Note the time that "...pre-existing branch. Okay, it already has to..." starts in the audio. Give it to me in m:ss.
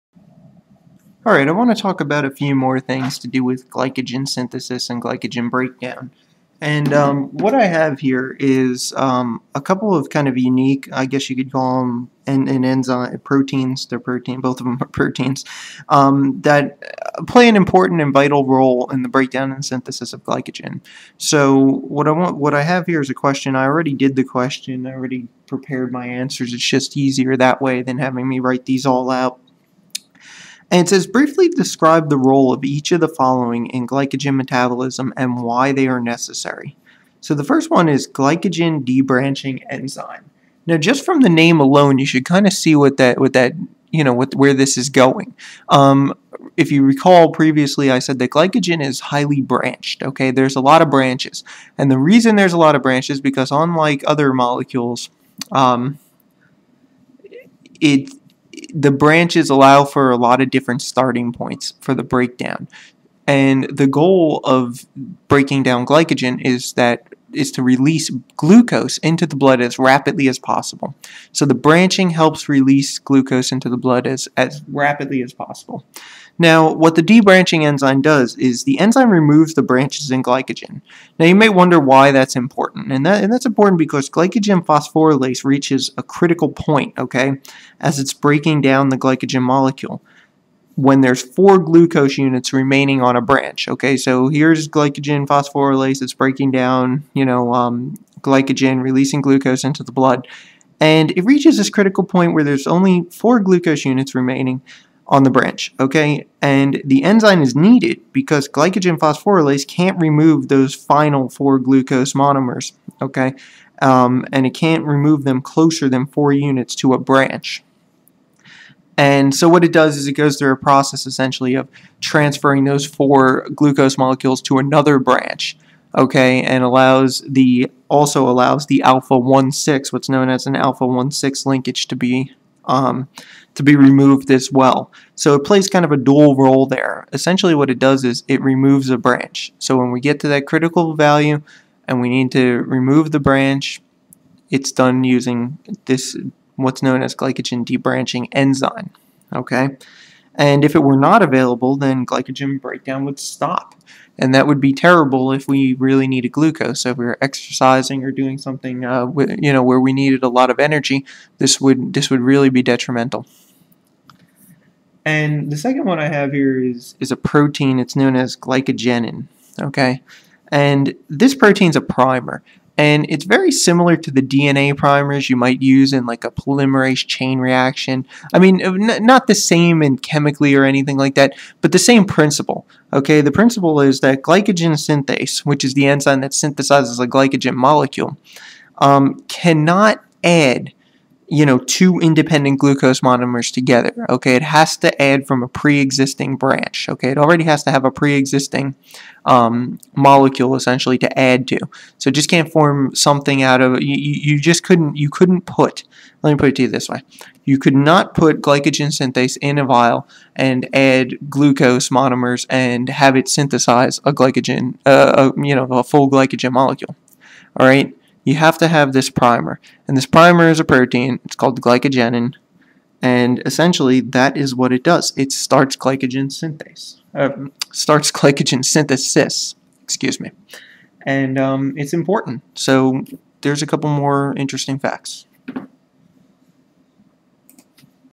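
3:15.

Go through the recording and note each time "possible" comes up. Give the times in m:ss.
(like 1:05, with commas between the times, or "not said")
1:10, 1:15.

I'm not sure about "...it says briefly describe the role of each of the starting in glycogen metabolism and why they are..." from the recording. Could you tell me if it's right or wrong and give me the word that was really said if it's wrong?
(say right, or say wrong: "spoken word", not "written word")
wrong: "following", not "starting".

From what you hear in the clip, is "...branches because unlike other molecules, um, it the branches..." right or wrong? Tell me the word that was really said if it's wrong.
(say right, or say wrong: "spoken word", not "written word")
right.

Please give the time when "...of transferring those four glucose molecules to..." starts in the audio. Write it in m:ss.
2:01.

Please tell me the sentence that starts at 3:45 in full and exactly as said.
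It starts glycogen synthase, uh, starts glycogen synthesis, excuse me.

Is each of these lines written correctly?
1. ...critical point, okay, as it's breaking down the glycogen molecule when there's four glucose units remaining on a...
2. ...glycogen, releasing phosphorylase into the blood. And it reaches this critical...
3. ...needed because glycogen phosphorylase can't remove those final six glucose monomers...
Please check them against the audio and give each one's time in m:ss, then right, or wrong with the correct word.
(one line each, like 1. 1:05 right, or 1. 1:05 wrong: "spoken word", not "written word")
1. 1:26 right
2. 1:38 wrong: "glucose", not "phosphorylase"
3. 1:47 wrong: "four", not "six".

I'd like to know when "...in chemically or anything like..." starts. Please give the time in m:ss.
2:59.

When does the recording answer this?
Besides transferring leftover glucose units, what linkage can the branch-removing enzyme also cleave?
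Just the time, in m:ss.
2:10.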